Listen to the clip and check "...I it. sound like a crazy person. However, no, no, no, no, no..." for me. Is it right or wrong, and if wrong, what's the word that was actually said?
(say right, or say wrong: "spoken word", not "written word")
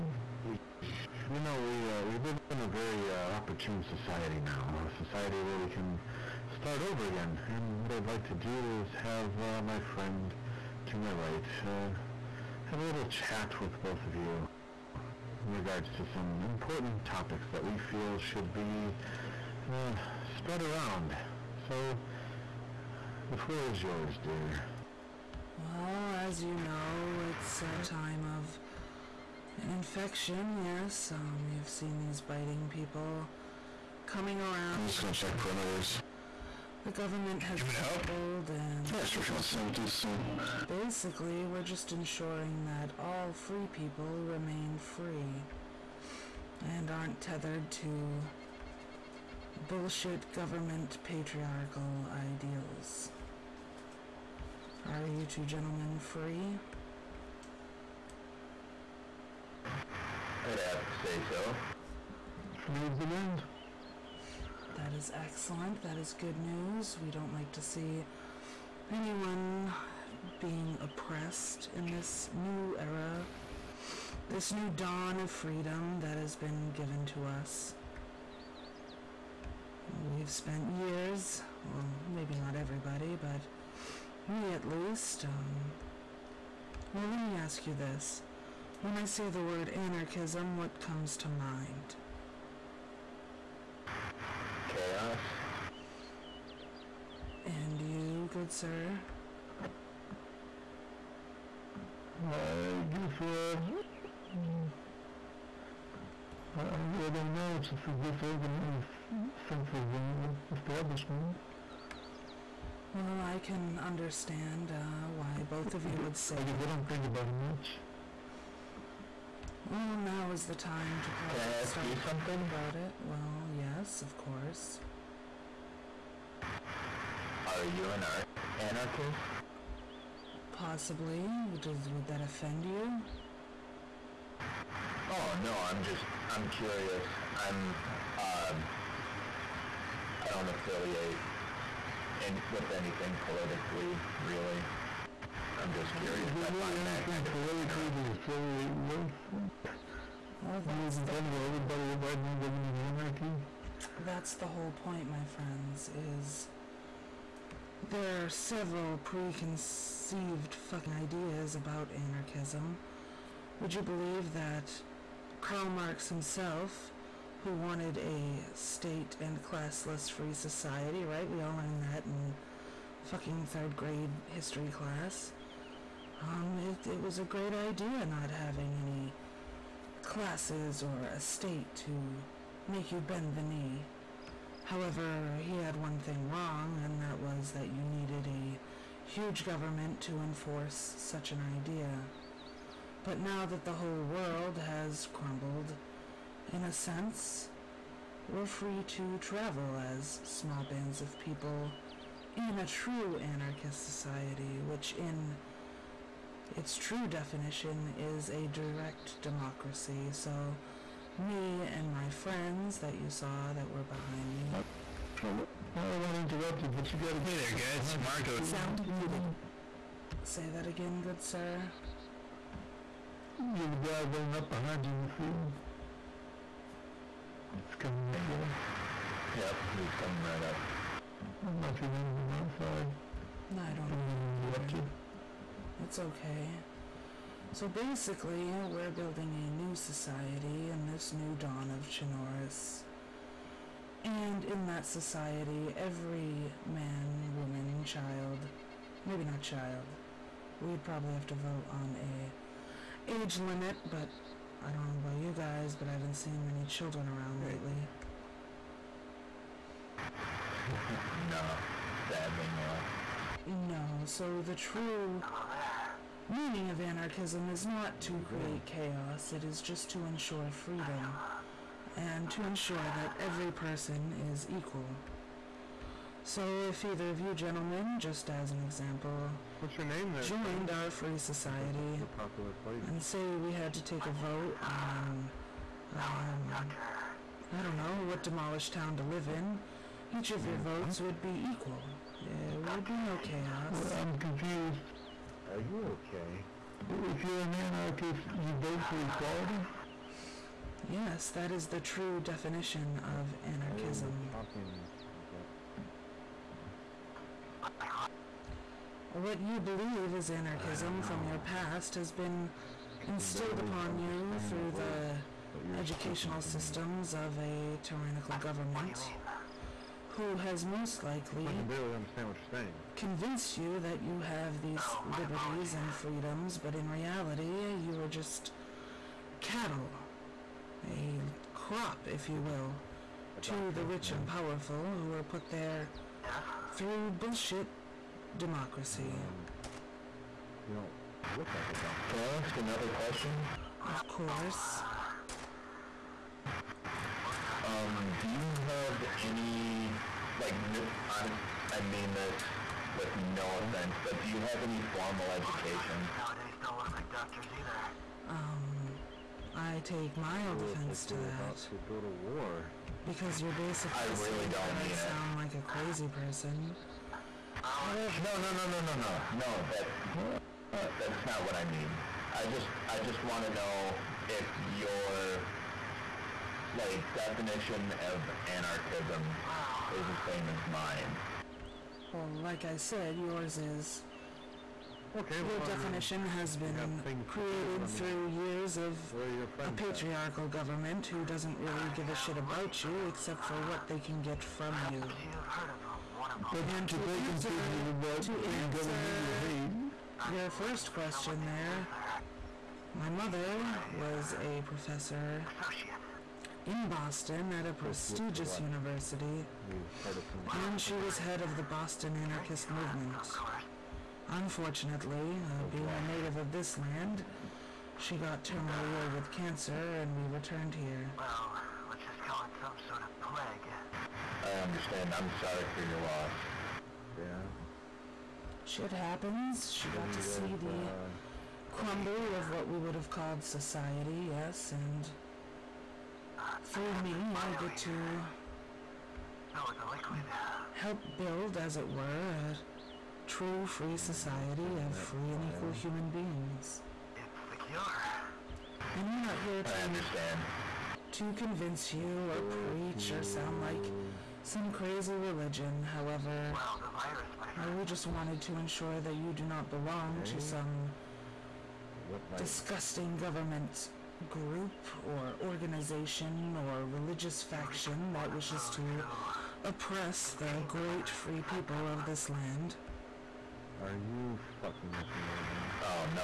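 right.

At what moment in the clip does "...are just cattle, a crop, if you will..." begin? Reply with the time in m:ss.
5:27.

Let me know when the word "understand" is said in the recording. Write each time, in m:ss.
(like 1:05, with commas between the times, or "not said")
1:53, 5:21, 7:04, 7:29.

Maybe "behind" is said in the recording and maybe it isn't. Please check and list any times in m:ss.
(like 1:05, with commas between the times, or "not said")
3:33, 3:44.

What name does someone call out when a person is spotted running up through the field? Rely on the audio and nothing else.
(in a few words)
Marco.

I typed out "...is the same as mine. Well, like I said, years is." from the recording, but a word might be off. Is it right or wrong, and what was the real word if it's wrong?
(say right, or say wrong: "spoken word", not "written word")
wrong: "yours", not "years".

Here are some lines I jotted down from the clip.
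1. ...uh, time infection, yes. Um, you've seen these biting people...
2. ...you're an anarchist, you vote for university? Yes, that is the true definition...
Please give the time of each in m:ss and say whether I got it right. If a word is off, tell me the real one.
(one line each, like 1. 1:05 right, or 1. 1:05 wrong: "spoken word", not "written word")
1. 0:27 right
2. 4:57 wrong: "equality", not "university".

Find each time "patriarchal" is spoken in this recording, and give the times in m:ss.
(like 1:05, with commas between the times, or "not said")
0:51, 6:29.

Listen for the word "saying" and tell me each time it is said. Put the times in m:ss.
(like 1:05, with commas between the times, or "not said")
5:22.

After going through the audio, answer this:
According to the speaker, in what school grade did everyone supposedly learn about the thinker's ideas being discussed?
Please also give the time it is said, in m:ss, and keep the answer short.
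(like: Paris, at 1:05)
Third grade, at 2:53.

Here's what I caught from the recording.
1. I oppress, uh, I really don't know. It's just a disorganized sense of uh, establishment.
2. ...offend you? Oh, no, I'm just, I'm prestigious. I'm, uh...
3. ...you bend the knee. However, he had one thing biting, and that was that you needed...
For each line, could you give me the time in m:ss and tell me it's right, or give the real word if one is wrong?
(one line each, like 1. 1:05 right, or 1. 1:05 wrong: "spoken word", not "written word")
1. 1:42 wrong: "guess", not "oppress"
2. 2:12 wrong: "curious", not "prestigious"
3. 3:02 wrong: "wrong", not "biting".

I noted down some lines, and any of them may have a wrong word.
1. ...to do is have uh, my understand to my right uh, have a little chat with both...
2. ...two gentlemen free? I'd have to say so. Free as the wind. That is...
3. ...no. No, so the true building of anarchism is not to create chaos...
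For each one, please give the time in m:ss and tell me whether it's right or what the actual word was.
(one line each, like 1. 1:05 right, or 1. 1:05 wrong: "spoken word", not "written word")
1. 0:08 wrong: "friend", not "understand"
2. 0:55 right
3. 4:22 wrong: "meaning", not "building".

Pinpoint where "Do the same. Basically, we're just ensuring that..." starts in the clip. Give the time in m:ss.
0:39.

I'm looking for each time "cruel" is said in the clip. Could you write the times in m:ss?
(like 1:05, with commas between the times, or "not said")
not said.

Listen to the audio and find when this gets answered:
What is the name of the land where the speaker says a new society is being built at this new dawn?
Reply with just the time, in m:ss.
4:01.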